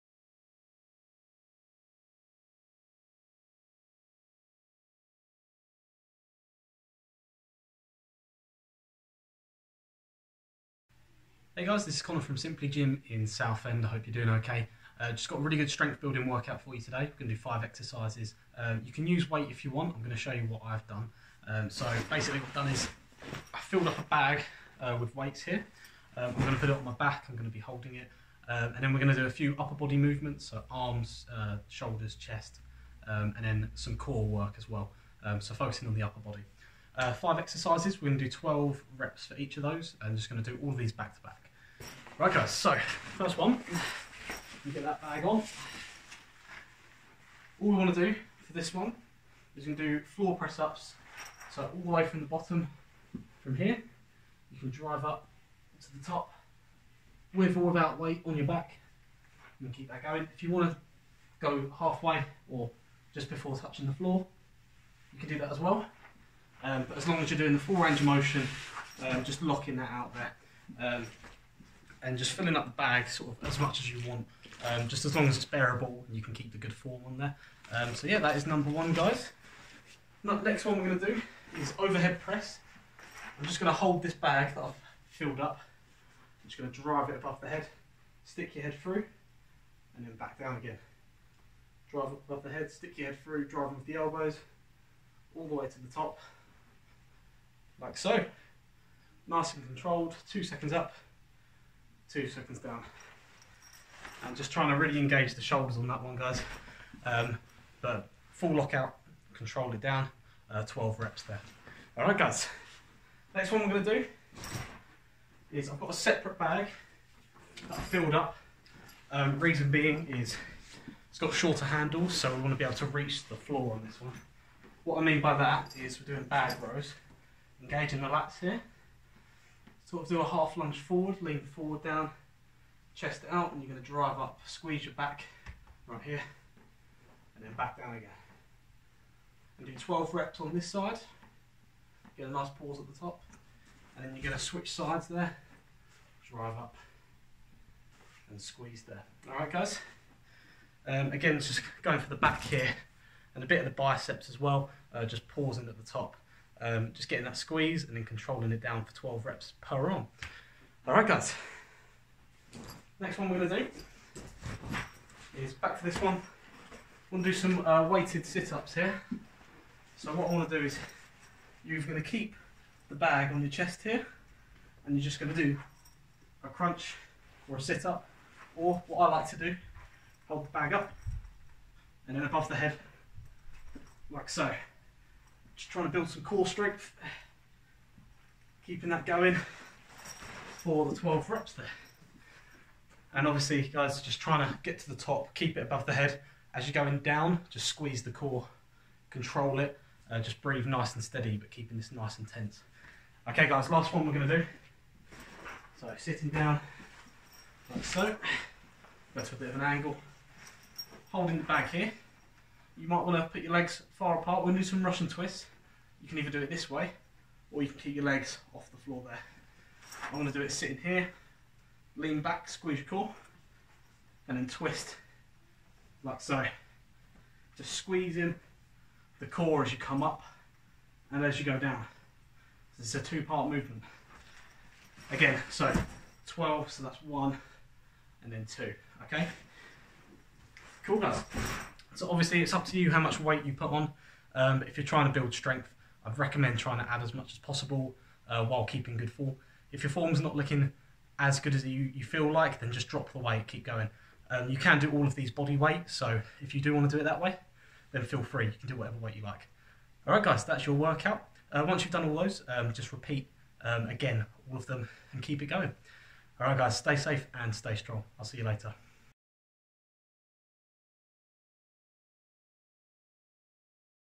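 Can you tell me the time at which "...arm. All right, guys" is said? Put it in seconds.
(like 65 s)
159 s.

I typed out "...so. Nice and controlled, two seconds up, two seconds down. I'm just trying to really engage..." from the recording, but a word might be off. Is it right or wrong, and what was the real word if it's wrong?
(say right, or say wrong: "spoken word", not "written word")
right.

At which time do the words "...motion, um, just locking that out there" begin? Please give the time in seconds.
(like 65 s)
68 s.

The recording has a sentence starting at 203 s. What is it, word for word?
Okay, guys, last one we're going to do.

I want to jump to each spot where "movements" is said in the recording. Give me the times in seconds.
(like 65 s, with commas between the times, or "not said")
29 s, 233 s.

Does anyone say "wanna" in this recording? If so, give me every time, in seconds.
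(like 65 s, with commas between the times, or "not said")
122 s, 170 s.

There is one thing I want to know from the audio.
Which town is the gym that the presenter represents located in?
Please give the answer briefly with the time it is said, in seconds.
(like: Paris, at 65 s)
Southend, at 13 s.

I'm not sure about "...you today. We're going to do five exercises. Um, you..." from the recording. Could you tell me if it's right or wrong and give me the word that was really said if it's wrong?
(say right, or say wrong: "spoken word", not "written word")
right.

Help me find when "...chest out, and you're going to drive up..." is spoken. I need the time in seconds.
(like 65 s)
132 s.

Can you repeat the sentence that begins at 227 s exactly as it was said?
Just squeezing the core as you come up and as you go down.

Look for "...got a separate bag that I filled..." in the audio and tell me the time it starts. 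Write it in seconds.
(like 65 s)
115 s.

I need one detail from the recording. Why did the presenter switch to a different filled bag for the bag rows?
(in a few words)
Shorter handles.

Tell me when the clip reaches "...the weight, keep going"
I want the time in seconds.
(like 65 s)
253 s.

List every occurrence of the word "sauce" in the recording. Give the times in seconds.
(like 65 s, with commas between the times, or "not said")
not said.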